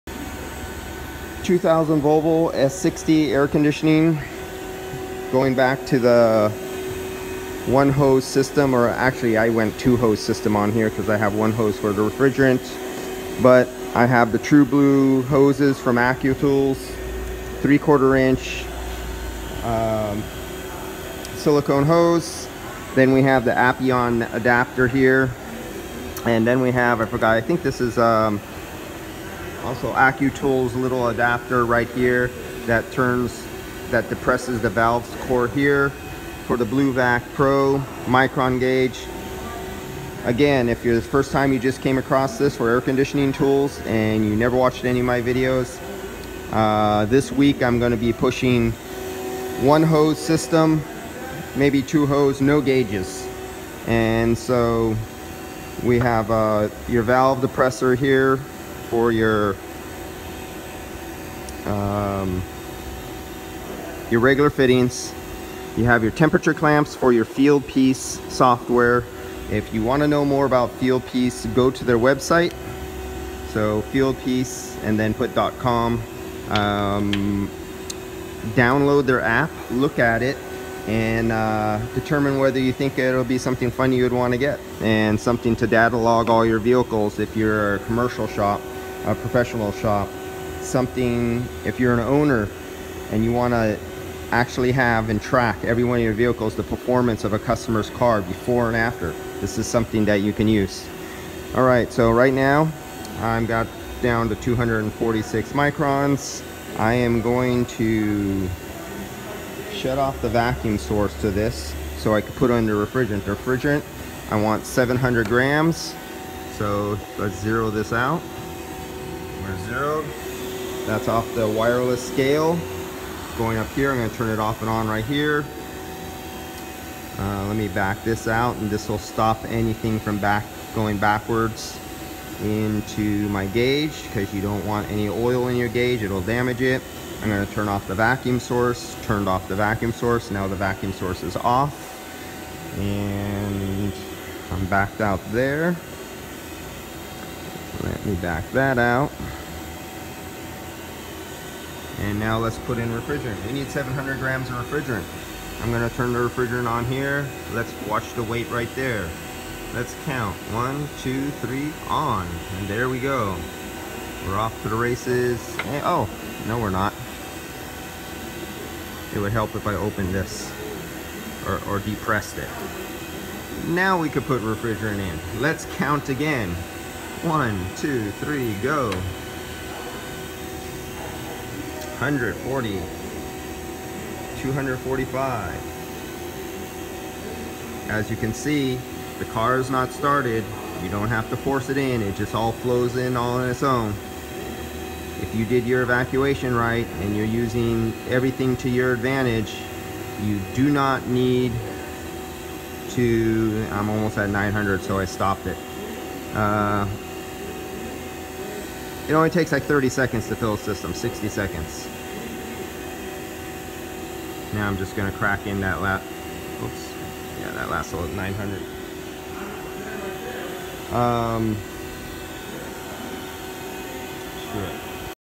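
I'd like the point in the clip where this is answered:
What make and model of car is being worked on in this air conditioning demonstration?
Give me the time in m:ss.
0:02.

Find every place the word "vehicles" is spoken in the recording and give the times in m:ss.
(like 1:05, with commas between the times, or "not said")
1:26, 1:36.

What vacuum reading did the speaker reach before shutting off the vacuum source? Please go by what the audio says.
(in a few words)
246 microns.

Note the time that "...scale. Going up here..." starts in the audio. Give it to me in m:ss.
2:02.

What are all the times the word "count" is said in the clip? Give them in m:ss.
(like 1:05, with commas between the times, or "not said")
2:40, 2:55.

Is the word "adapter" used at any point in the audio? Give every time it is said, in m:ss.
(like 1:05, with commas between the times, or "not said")
0:24, 0:31.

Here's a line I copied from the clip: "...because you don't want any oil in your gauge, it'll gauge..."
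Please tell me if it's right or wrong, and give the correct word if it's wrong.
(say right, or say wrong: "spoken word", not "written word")
wrong: "damage", not "gauge".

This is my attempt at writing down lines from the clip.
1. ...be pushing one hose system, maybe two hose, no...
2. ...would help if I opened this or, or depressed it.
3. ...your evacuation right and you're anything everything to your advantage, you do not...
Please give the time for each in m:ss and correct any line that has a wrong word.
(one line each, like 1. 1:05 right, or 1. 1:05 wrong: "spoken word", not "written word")
1. 0:47 right
2. 2:49 right
3. 3:15 wrong: "using", not "anything".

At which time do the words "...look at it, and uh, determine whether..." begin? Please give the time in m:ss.
1:19.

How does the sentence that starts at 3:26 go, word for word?
Uh, it only takes like 30 seconds to fill a system, 60 seconds.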